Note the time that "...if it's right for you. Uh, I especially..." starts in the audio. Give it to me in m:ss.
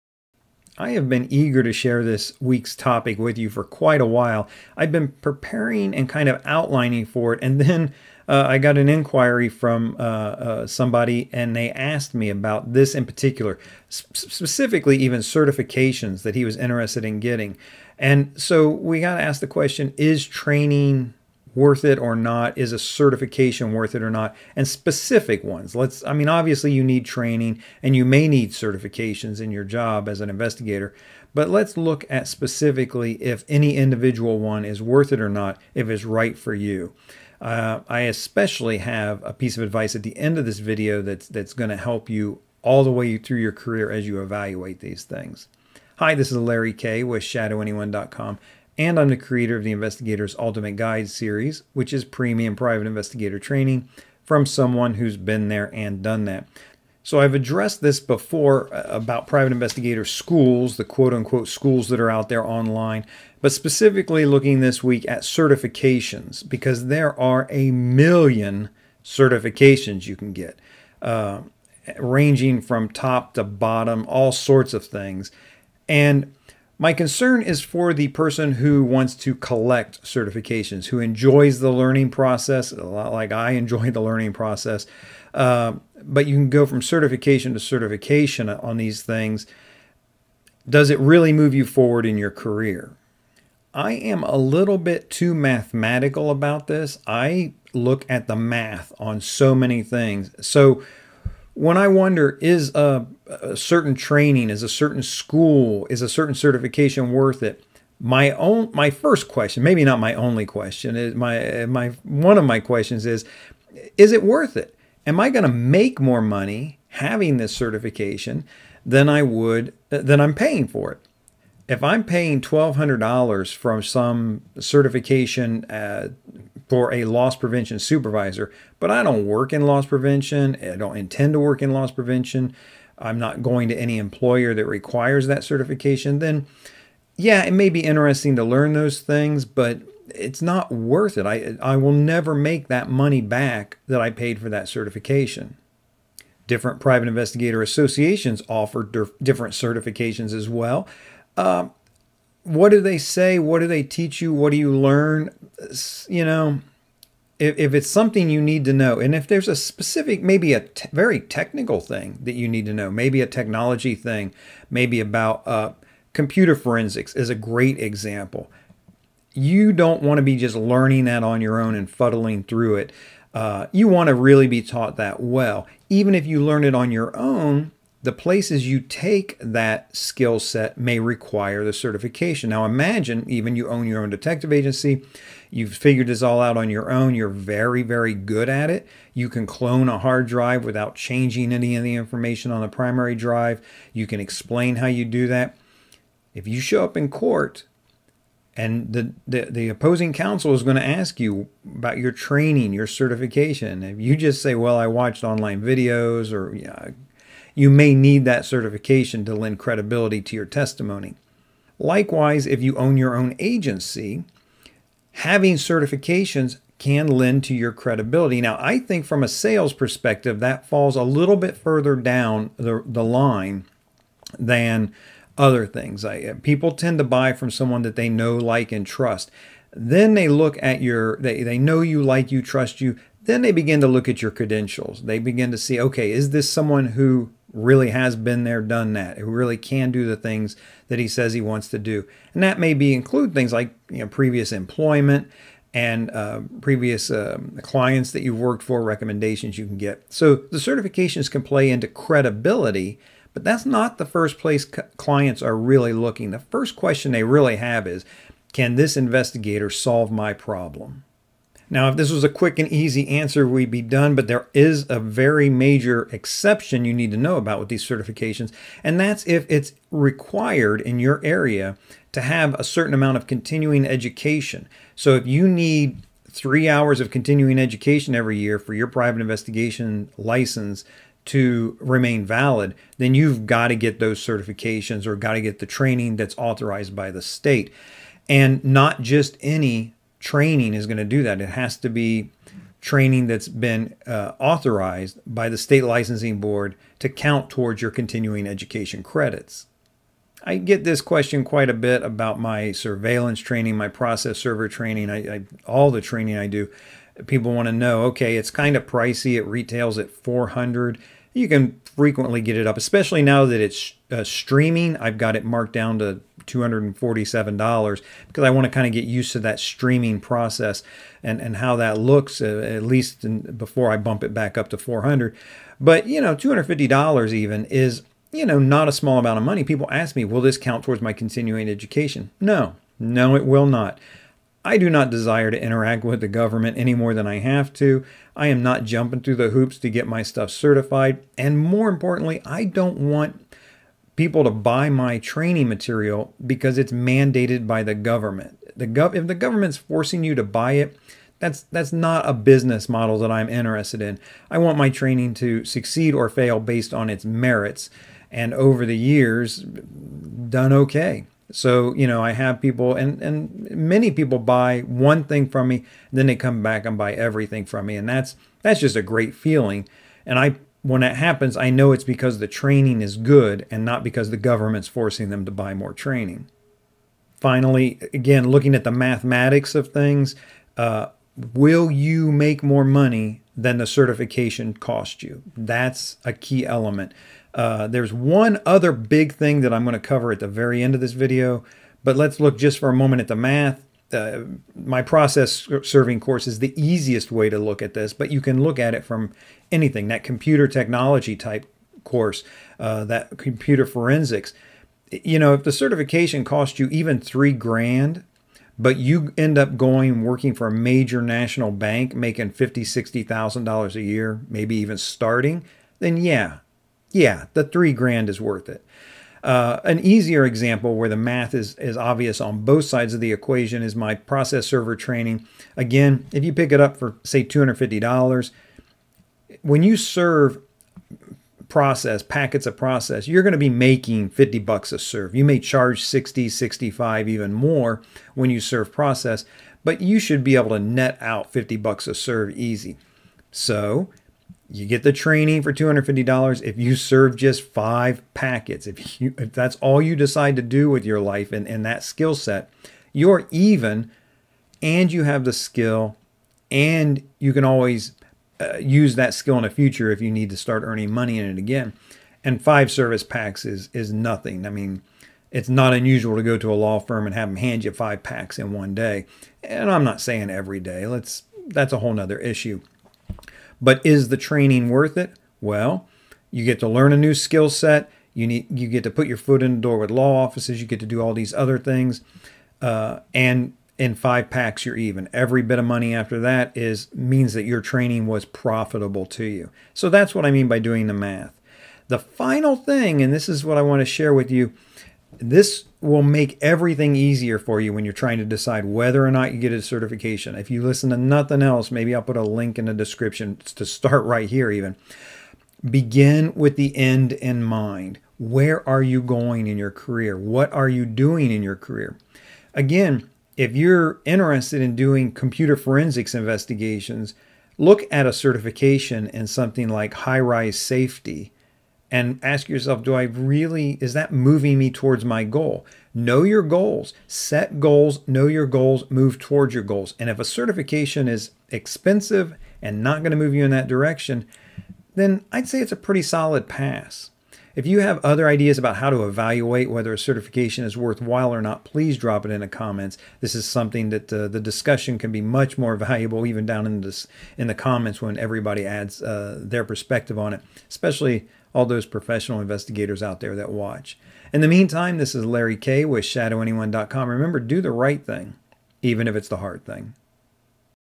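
0:35.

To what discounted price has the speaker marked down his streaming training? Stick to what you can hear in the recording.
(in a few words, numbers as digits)
$247.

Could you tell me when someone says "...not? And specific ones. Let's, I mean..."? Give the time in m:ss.
0:24.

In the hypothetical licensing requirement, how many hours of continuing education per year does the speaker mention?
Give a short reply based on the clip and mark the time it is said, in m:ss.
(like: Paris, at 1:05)
3, at 4:36.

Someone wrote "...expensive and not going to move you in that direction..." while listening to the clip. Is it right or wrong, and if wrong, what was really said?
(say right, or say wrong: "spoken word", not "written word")
right.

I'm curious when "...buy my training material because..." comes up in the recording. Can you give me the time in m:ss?
5:44.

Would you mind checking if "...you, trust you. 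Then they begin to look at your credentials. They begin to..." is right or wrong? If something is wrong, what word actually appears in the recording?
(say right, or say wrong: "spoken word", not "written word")
right.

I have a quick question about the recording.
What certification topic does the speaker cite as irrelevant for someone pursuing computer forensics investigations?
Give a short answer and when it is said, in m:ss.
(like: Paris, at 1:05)
high rise safety, at 8:40.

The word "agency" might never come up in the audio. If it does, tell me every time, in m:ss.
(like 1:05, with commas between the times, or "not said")
3:04, 3:33.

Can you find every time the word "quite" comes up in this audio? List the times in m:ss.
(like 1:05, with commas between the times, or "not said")
0:03, 5:01.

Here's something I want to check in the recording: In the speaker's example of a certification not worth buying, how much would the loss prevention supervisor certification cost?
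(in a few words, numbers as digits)
$1,200.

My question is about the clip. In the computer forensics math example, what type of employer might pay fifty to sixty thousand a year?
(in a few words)
major national bank.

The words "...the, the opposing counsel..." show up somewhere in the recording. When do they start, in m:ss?
3:19.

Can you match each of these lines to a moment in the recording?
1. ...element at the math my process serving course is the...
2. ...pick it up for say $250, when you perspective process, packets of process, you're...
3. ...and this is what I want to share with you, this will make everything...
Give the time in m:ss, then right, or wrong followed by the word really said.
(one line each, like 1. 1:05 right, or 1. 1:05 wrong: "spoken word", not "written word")
1. 6:32 wrong: "moment", not "element"
2. 7:06 wrong: "serve", not "perspective"
3. 8:13 right.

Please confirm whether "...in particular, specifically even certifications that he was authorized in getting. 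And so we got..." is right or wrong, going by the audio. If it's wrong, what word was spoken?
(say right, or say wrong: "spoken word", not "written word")
wrong: "interested", not "authorized".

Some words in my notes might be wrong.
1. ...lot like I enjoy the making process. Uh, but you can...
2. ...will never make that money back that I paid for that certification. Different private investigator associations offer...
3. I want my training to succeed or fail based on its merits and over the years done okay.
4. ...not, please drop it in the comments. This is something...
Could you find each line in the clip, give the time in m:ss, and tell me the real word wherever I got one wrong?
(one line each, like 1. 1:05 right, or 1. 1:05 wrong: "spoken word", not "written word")
1. 1:22 wrong: "learning", not "making"
2. 2:21 right
3. 5:54 right
4. 9:01 right.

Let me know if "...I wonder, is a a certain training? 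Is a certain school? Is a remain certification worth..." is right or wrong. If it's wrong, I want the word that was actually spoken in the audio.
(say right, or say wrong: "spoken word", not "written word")
wrong: "certain", not "remain".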